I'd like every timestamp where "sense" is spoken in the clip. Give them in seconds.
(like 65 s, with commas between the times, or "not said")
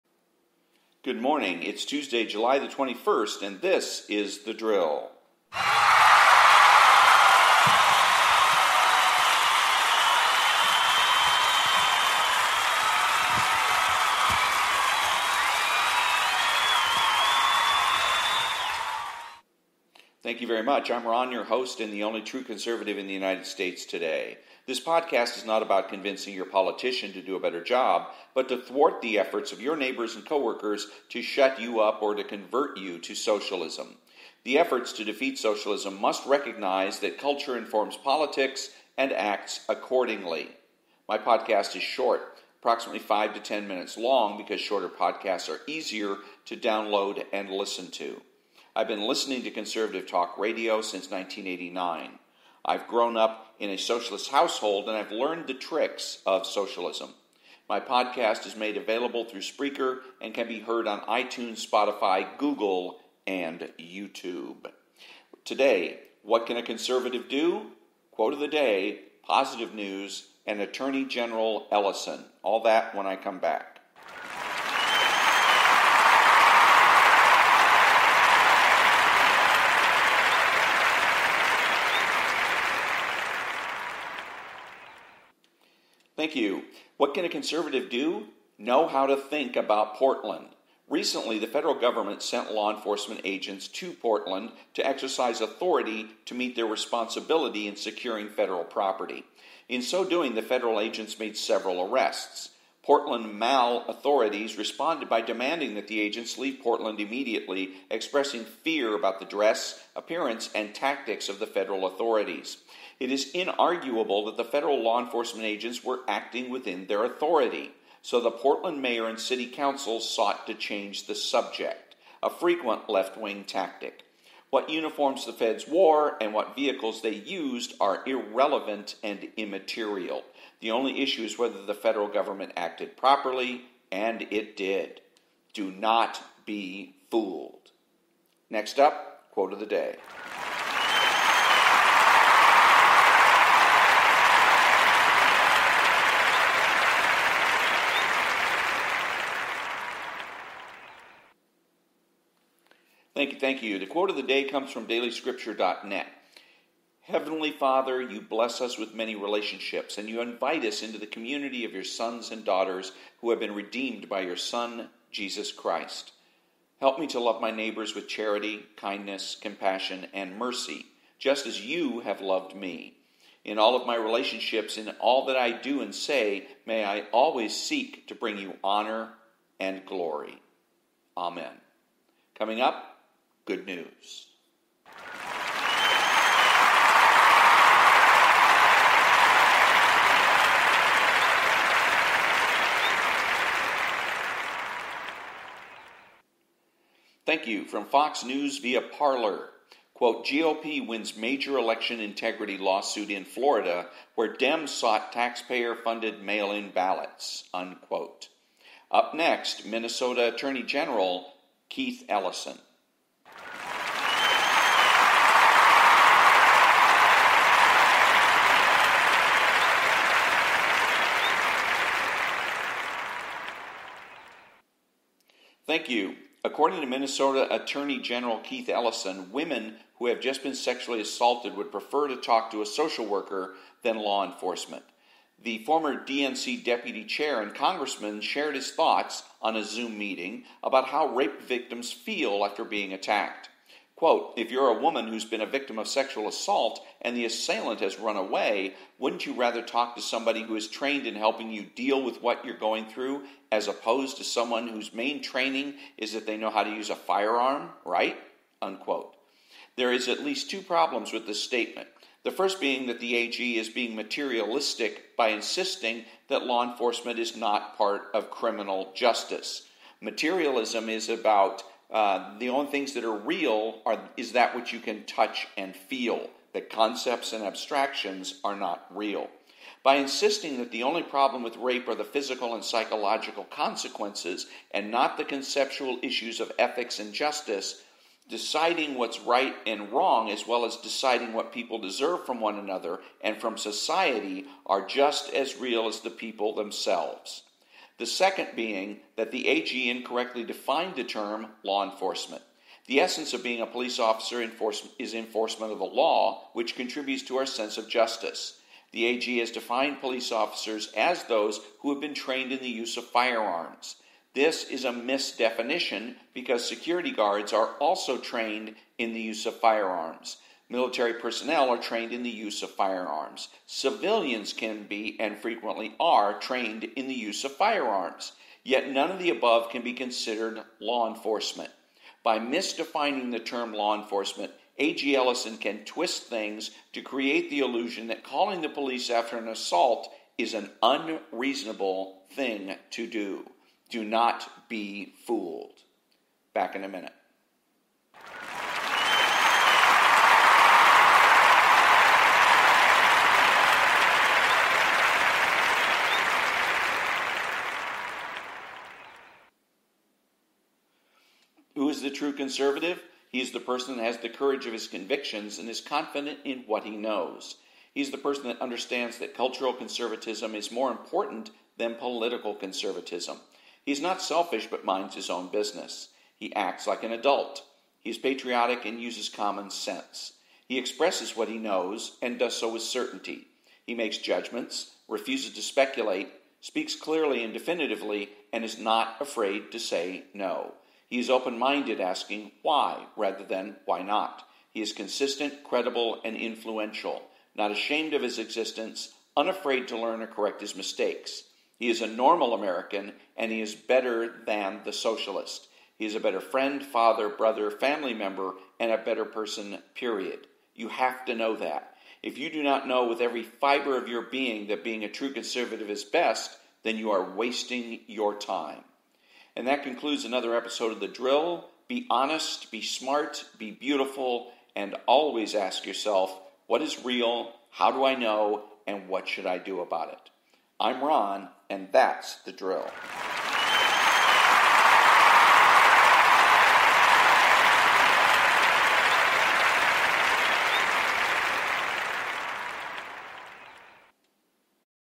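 307 s, 379 s.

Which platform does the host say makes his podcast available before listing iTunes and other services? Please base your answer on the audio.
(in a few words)
Spreaker.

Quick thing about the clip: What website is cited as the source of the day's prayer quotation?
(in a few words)
dailyscripture.net.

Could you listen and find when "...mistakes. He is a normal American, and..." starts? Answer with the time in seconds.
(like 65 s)
400 s.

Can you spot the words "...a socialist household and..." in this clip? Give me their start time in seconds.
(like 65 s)
53 s.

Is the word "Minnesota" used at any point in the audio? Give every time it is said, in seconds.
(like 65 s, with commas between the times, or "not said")
209 s, 226 s.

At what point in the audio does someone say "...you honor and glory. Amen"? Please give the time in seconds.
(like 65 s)
178 s.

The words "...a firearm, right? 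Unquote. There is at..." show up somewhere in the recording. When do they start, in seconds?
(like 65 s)
256 s.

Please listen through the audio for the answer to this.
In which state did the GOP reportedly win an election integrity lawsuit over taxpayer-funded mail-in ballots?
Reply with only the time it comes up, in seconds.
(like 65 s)
203 s.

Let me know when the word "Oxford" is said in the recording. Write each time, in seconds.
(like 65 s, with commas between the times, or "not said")
not said.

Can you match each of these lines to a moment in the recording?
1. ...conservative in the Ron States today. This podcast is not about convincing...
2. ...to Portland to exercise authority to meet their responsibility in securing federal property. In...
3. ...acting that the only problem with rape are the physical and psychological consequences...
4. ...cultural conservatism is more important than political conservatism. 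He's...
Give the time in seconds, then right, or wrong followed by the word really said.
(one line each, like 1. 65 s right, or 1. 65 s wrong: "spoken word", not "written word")
1. 22 s wrong: "United", not "Ron"
2. 93 s right
3. 279 s wrong: "insisting", not "acting"
4. 369 s right.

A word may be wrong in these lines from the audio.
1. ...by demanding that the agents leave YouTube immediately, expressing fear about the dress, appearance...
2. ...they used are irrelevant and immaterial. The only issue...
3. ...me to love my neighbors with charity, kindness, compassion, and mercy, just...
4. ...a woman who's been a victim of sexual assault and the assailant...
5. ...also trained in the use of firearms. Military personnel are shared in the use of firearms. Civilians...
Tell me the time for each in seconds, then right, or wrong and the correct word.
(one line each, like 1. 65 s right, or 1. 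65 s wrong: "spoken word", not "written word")
1. 105 s wrong: "Portland", not "YouTube"
2. 127 s right
3. 166 s right
4. 244 s right
5. 317 s wrong: "trained", not "shared".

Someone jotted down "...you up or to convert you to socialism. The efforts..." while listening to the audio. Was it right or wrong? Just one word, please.
right.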